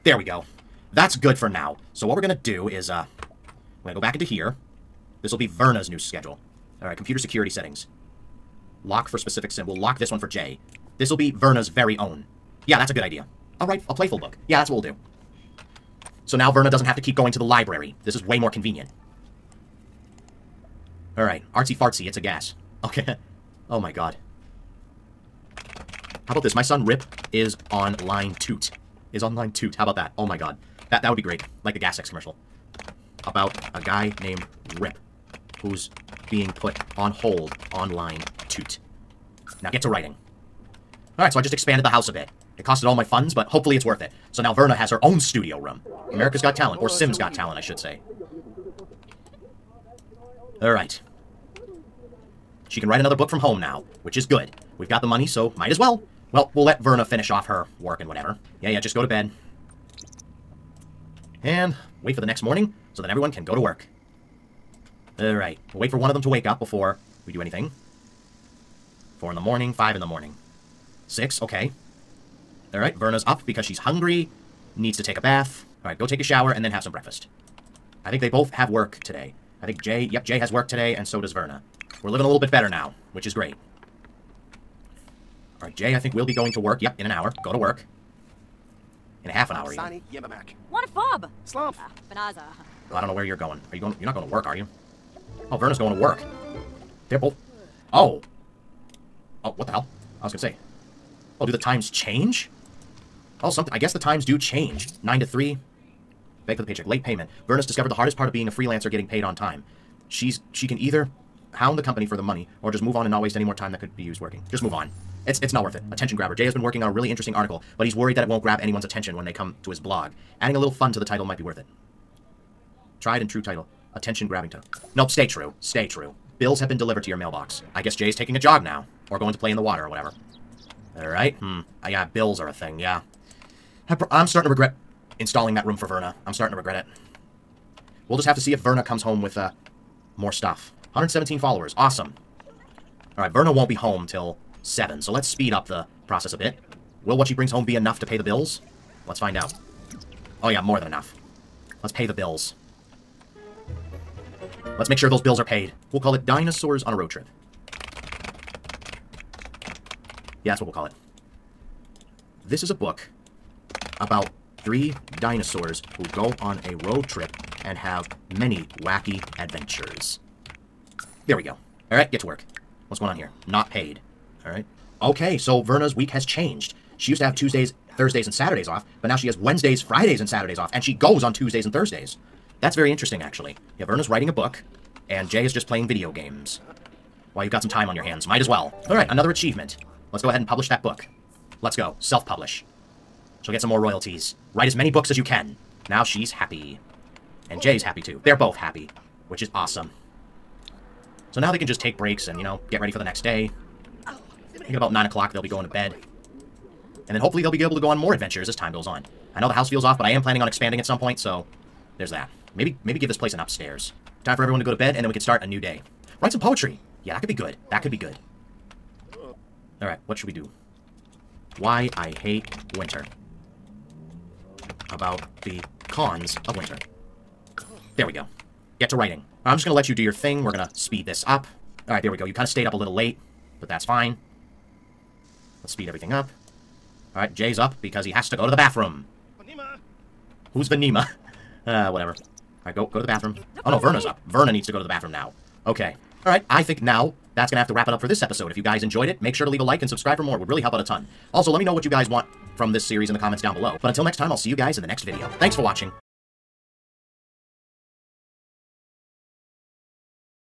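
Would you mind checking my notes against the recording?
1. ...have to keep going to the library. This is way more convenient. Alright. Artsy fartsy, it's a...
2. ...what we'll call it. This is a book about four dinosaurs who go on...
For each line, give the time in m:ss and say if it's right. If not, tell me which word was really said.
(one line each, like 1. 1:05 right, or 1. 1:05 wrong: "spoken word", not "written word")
1. 0:16 right
2. 2:40 wrong: "three", not "four".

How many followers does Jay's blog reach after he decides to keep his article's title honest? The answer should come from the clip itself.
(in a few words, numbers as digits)
117.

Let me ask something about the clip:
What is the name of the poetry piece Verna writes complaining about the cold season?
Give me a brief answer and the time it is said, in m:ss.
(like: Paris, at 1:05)
Why I hate winter, at 3:41.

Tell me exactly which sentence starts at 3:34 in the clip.
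Time for everyone to go to bed, and then we can start a new day.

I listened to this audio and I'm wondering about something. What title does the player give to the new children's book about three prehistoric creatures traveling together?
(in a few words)
Dinosaurs on a Road Trip.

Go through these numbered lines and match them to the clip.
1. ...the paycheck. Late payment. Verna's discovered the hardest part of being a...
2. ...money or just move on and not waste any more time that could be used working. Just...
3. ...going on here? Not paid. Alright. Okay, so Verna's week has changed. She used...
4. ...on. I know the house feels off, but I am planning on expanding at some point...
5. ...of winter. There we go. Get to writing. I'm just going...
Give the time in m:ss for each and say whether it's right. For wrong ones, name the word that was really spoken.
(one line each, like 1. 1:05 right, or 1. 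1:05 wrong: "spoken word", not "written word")
1. 1:46 right
2. 1:52 right
3. 2:52 right
4. 3:28 right
5. 3:46 right.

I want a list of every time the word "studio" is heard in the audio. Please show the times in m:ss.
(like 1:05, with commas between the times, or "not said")
0:45.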